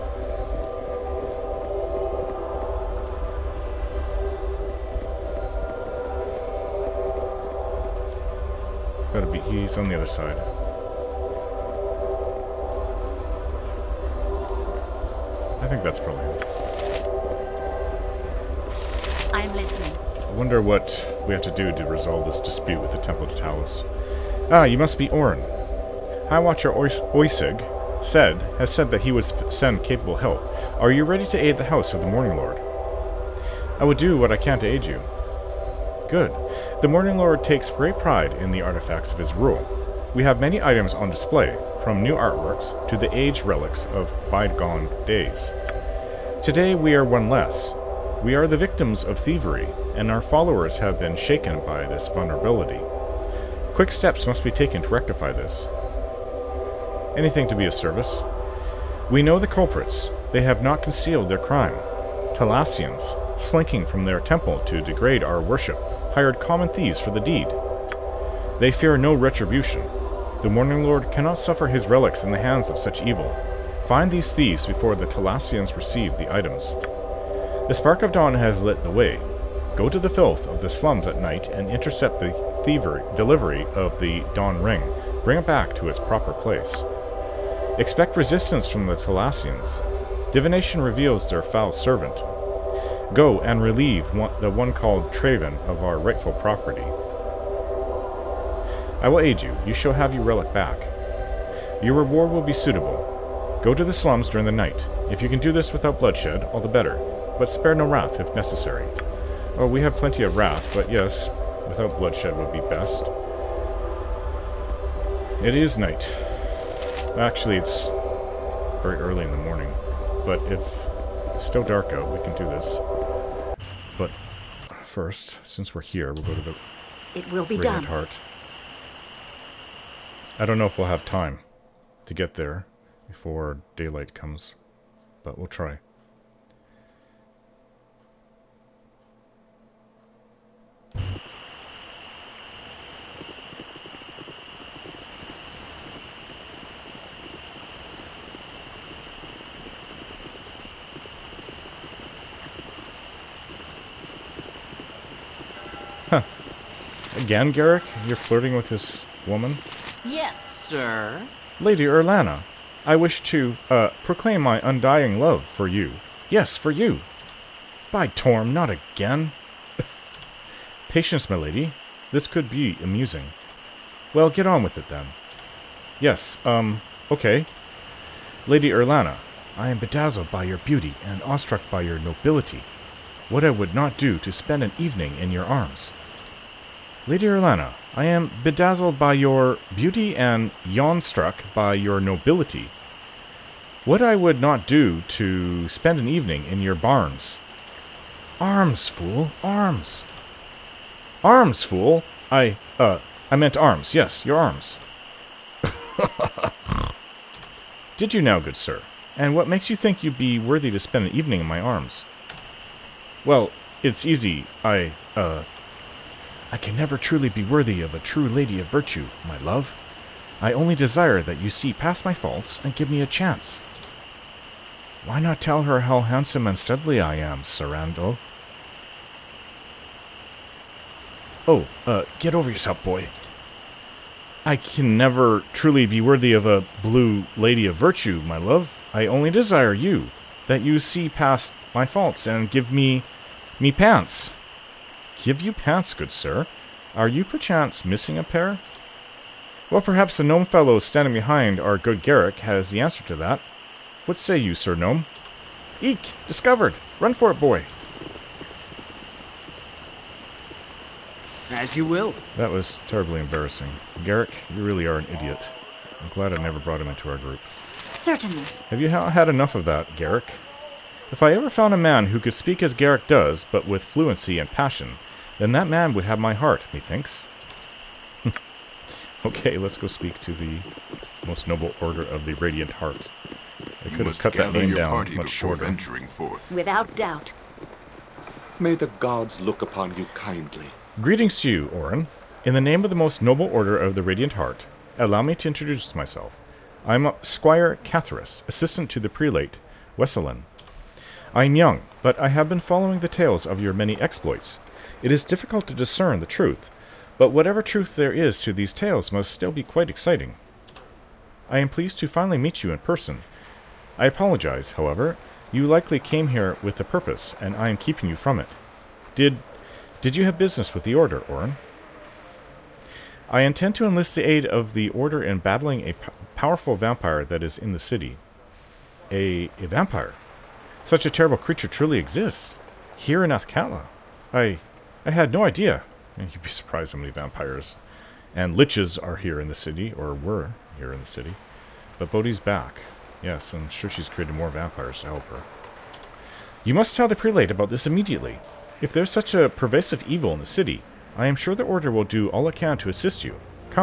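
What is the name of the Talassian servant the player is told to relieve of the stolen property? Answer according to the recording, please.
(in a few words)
Travin.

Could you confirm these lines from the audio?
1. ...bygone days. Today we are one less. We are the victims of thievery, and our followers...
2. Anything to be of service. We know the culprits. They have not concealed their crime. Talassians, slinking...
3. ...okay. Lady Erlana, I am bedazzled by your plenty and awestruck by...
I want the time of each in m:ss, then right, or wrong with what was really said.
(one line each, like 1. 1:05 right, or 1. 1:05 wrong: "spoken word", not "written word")
1. 0:44 right
2. 0:57 right
3. 2:57 wrong: "beauty", not "plenty".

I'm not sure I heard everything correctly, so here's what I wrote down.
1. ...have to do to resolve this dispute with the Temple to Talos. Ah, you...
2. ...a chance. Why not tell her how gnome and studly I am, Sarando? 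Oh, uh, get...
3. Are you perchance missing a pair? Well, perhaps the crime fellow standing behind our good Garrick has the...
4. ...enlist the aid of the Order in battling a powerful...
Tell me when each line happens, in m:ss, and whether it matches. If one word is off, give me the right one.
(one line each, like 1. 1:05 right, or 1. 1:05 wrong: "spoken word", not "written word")
1. 0:21 right
2. 3:43 wrong: "handsome", not "gnome"
3. 4:06 wrong: "gnome", not "crime"
4. 5:23 right.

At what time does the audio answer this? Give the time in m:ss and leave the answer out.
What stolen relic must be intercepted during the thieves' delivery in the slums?
1:24.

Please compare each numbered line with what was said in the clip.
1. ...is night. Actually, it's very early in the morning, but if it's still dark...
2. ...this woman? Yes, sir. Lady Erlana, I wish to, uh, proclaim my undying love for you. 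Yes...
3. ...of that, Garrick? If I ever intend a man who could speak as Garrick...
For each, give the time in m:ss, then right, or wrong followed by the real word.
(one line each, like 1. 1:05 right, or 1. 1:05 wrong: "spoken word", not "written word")
1. 1:55 right
2. 2:38 right
3. 4:29 wrong: "found", not "intend".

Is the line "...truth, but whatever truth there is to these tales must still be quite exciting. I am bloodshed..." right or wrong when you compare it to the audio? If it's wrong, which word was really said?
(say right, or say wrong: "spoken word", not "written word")
wrong: "pleased", not "bloodshed".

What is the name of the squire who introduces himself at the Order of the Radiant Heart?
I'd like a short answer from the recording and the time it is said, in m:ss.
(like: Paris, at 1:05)
Catharus, at 4:57.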